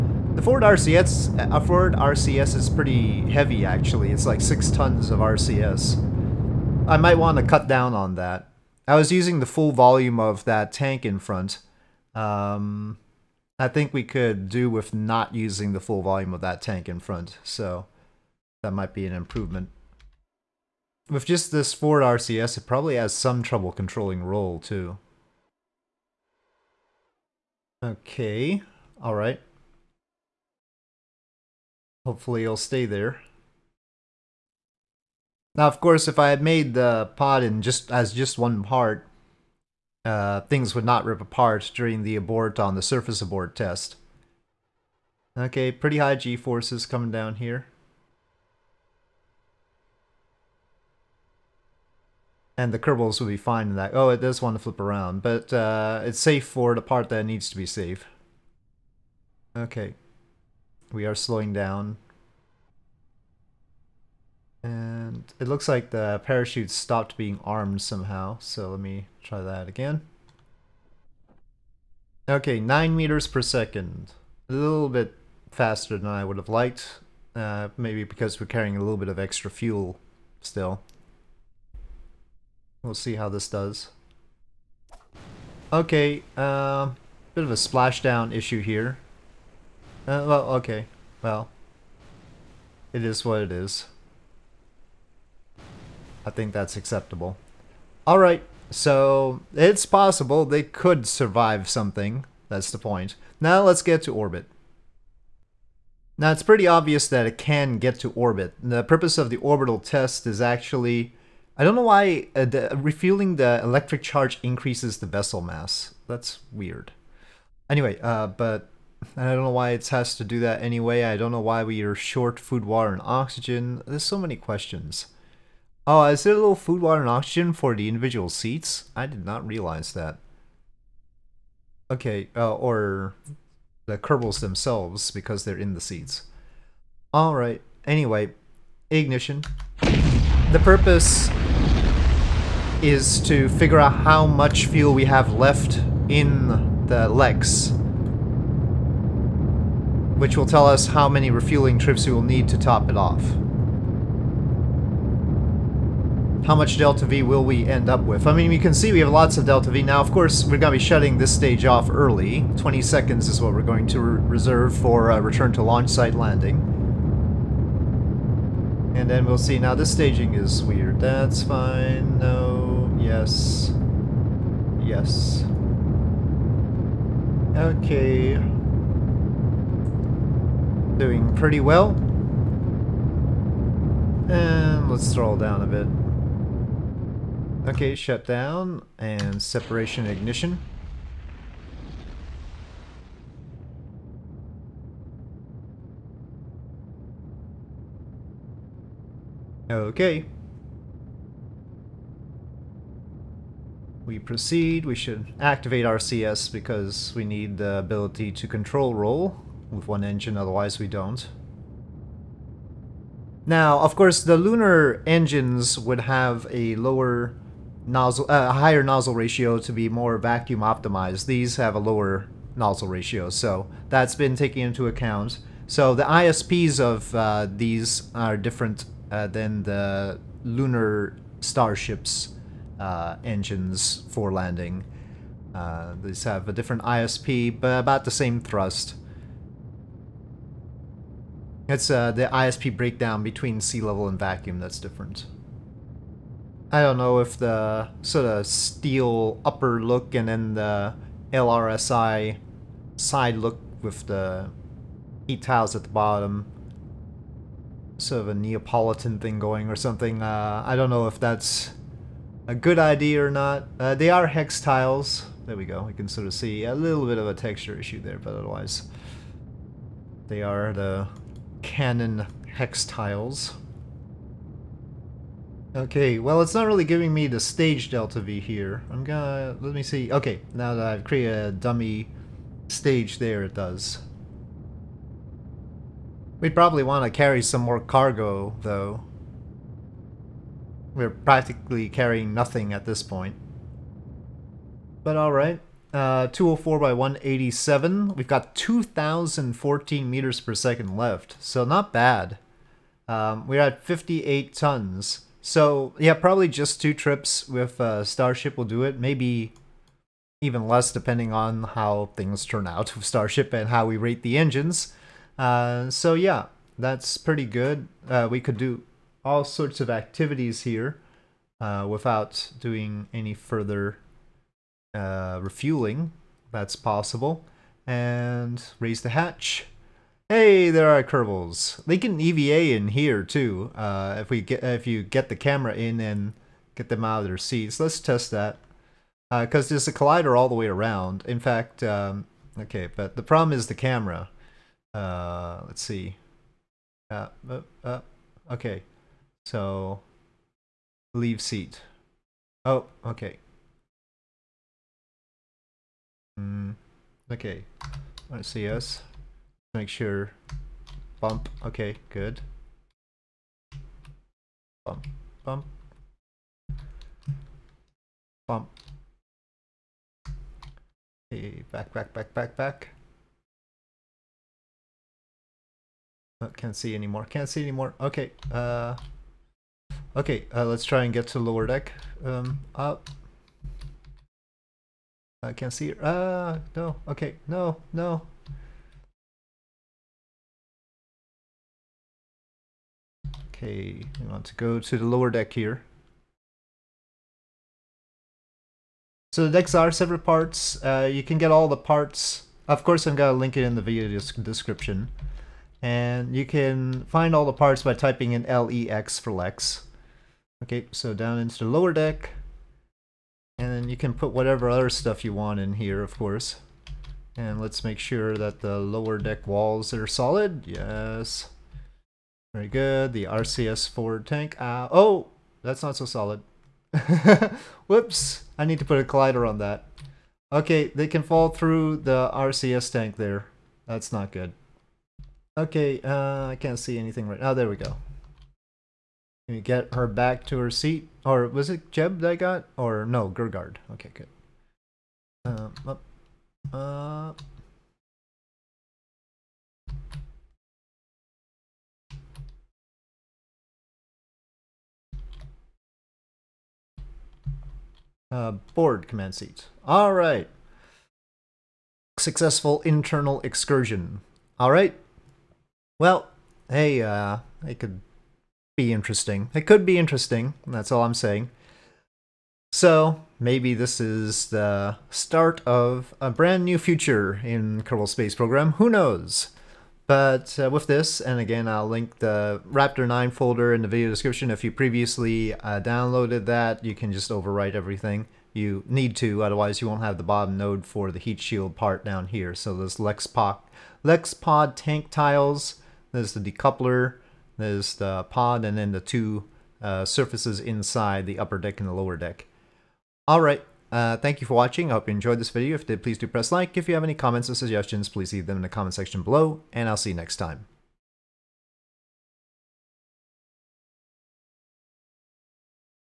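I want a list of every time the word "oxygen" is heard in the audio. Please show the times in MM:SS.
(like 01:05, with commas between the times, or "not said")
02:03, 02:07.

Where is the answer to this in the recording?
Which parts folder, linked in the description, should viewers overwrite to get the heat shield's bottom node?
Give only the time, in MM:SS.
08:02.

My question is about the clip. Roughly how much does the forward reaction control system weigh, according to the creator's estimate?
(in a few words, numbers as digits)
6 tons.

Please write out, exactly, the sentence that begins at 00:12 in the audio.
Um, I think we could do with not using the full volume of that tank in front.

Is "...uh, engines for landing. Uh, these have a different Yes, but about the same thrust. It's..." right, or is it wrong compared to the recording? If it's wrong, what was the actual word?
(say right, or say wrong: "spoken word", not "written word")
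wrong: "ISP", not "Yes".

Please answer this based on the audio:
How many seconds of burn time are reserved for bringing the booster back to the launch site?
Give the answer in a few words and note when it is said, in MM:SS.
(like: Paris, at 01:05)
20 seconds, at 02:42.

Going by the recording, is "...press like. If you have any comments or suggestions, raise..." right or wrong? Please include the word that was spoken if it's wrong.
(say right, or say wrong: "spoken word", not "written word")
wrong: "please", not "raise".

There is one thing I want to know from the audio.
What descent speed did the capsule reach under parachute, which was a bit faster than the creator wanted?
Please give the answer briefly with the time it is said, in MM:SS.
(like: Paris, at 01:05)
9 meters per second, at 01:12.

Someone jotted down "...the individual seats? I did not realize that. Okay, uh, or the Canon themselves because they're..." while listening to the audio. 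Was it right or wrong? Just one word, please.
wrong.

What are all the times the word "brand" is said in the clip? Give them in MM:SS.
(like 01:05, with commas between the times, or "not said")
07:56.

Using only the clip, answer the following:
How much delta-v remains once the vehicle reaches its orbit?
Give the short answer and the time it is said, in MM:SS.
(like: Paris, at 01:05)
2,014 m/s, at 04:58.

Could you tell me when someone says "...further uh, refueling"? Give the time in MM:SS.
05:23.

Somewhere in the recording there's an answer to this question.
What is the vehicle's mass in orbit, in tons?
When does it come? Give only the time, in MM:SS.
05:03.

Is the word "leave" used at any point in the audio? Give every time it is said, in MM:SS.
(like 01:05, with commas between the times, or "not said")
05:51, 08:28.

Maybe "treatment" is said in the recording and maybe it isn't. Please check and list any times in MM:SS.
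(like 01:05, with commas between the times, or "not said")
not said.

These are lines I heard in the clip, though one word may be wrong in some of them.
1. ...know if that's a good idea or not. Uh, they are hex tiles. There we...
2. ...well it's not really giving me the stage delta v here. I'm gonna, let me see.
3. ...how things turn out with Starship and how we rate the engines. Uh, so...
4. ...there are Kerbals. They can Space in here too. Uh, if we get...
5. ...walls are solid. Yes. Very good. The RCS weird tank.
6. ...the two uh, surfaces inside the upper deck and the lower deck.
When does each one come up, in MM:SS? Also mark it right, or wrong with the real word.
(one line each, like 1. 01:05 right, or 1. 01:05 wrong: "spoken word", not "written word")
1. 04:20 right
2. 04:36 right
3. 05:11 right
4. 05:30 wrong: "EVA", not "Space"
5. 06:59 wrong: "forward", not "weird"
6. 08:18 right.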